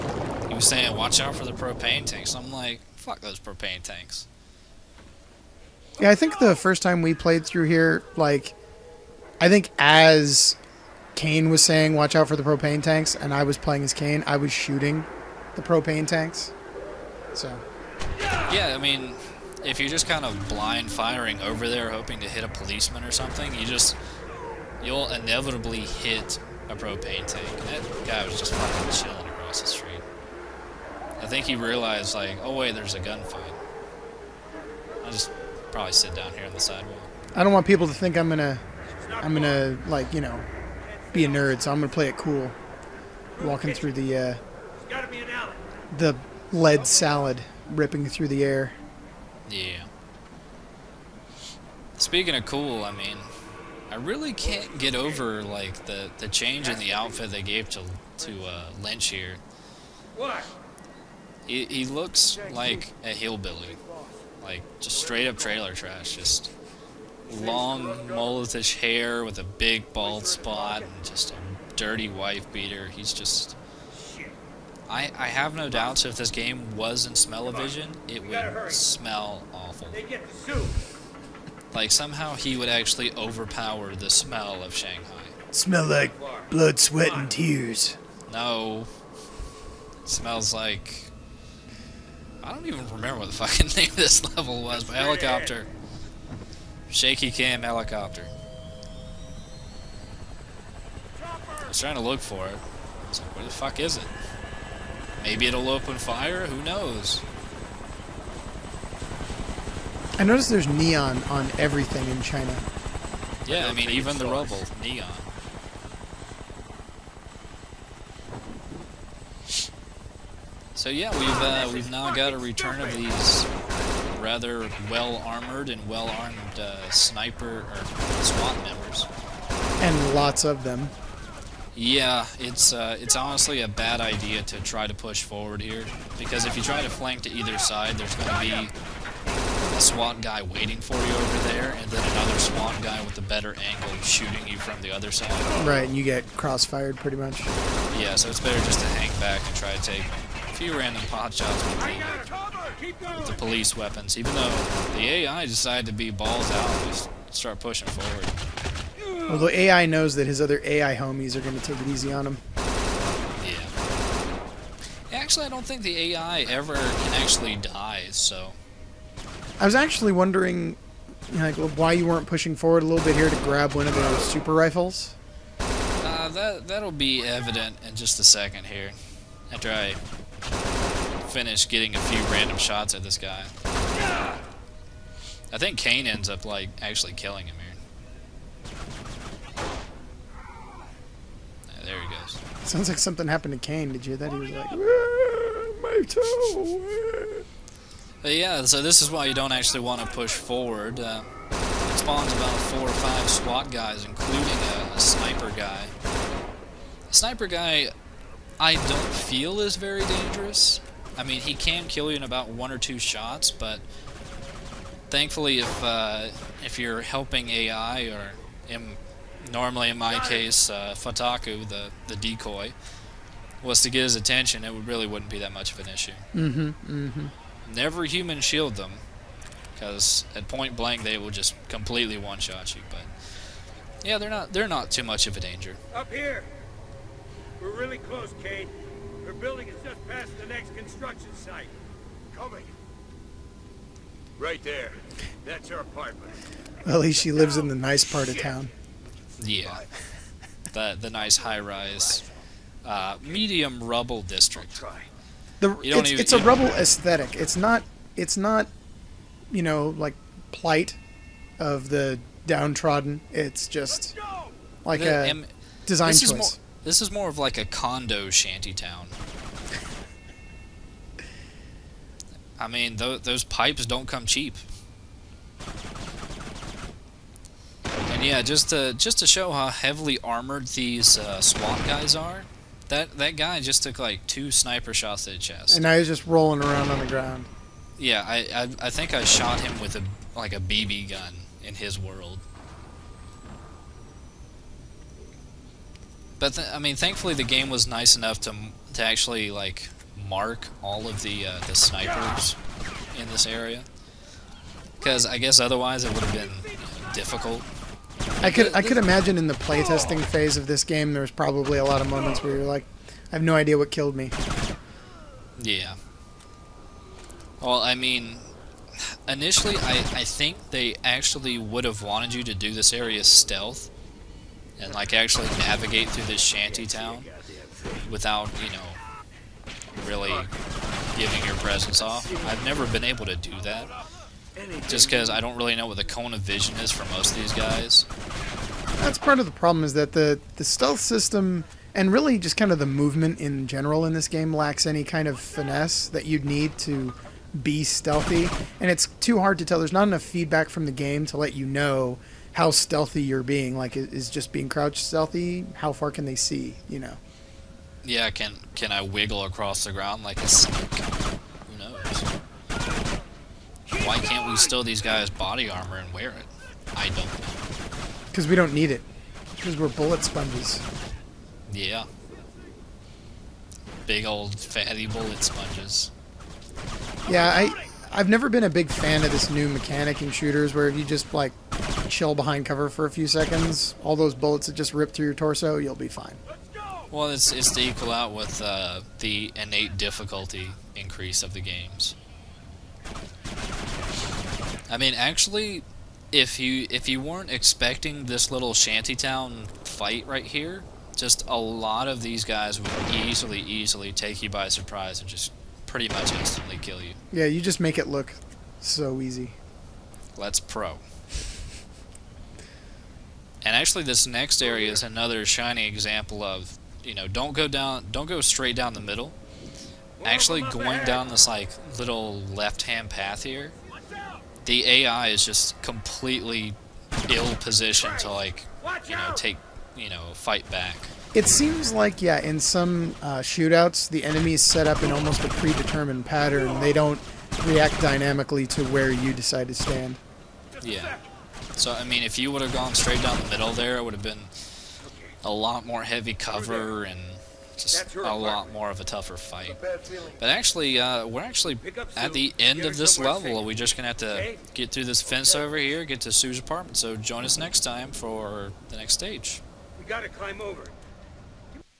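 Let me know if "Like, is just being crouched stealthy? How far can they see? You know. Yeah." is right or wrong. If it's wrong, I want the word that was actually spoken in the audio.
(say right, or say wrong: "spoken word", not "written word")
right.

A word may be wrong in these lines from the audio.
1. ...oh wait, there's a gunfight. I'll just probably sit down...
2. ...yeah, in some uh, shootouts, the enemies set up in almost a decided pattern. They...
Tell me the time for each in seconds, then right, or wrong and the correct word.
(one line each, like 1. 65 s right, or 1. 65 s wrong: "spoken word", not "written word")
1. 32 s right
2. 432 s wrong: "predetermined", not "decided".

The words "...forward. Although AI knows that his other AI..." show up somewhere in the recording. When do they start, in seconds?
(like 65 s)
157 s.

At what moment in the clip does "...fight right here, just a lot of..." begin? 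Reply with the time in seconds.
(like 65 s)
399 s.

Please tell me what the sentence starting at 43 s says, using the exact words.
Walking through the uh, the lead salad ripping through the air.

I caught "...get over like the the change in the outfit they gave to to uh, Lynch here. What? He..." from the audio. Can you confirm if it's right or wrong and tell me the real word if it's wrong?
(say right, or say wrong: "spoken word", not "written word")
right.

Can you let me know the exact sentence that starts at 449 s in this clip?
But actually, uh, we're actually at the end of this level.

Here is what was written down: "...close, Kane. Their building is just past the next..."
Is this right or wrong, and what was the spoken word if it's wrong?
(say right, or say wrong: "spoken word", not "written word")
right.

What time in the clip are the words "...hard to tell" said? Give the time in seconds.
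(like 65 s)
349 s.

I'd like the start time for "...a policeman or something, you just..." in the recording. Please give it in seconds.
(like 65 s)
22 s.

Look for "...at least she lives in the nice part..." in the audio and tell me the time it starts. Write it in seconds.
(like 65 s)
246 s.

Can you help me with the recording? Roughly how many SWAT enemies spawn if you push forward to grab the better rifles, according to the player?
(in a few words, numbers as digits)
4 or 5.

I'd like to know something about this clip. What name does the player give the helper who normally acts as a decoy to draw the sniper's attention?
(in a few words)
Futaku.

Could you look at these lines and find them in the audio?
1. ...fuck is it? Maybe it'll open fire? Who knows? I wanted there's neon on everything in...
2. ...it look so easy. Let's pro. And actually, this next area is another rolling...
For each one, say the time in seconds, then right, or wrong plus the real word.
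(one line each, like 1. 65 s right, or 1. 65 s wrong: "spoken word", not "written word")
1. 103 s wrong: "noticed", not "wanted"
2. 407 s wrong: "shining", not "rolling".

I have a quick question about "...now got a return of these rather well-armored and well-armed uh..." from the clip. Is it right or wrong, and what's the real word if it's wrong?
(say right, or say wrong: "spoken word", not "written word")
right.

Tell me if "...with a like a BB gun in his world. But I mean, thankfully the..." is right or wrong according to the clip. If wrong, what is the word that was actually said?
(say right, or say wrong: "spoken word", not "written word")
right.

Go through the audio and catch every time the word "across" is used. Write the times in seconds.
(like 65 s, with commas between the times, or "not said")
29 s, 359 s.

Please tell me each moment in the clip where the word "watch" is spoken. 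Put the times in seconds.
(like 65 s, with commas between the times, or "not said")
0 s, 11 s.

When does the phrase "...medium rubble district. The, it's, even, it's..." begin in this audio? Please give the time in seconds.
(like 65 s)
253 s.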